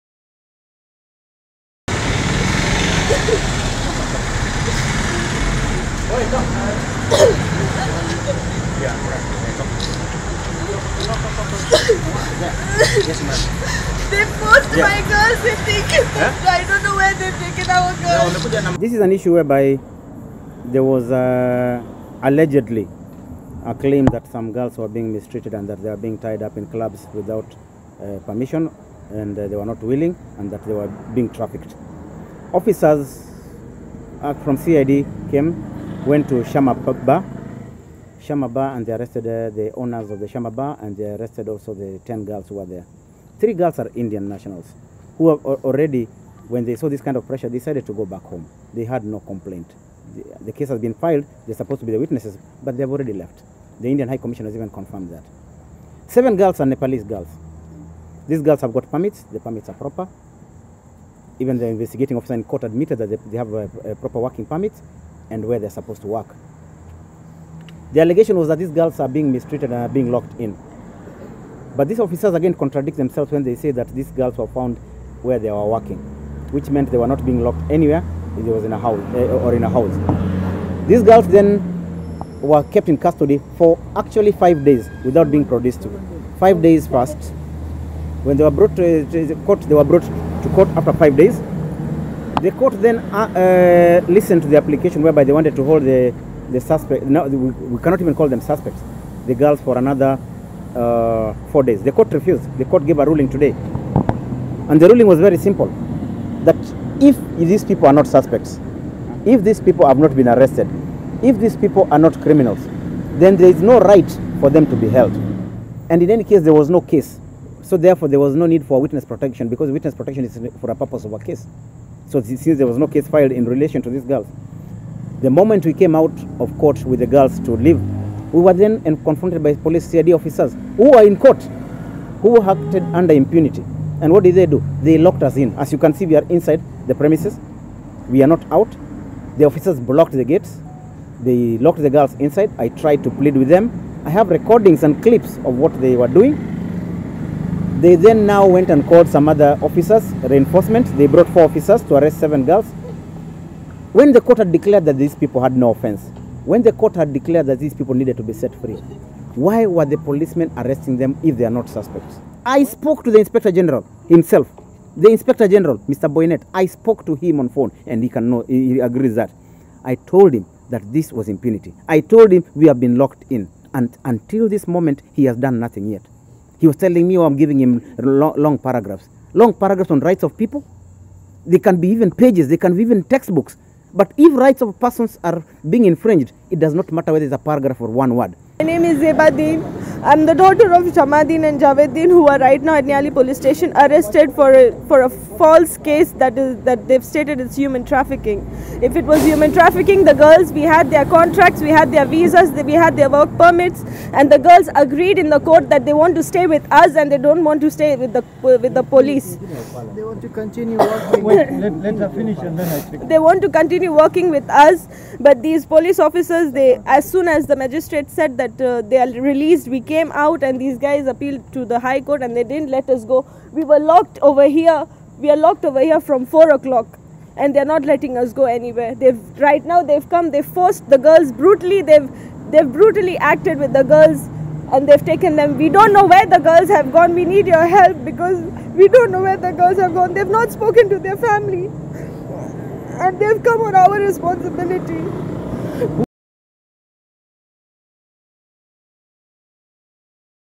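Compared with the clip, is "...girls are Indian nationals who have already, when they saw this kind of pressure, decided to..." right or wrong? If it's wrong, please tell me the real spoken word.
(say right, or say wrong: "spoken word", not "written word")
right.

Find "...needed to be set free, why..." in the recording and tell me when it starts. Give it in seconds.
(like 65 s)
157 s.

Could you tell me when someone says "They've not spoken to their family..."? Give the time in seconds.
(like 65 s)
240 s.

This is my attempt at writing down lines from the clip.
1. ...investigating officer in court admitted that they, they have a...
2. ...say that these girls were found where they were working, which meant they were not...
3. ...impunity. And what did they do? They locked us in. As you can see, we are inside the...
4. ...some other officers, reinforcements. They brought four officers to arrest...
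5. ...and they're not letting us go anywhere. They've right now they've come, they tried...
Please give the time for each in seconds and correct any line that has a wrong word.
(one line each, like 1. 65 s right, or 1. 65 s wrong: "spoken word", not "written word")
1. 61 s right
2. 73 s right
3. 133 s right
4. 149 s right
5. 227 s wrong: "forced", not "tried".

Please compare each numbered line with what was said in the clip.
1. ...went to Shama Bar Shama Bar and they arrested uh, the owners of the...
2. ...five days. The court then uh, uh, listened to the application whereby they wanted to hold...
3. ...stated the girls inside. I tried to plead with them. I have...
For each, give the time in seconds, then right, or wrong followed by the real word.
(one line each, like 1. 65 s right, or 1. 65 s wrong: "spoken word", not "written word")
1. 36 s right
2. 90 s right
3. 141 s wrong: "locked", not "stated".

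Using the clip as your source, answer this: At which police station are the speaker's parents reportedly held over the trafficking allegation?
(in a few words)
Nyali.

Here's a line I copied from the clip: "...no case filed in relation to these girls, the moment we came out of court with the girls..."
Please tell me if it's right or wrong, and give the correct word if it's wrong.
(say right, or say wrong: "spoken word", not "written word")
right.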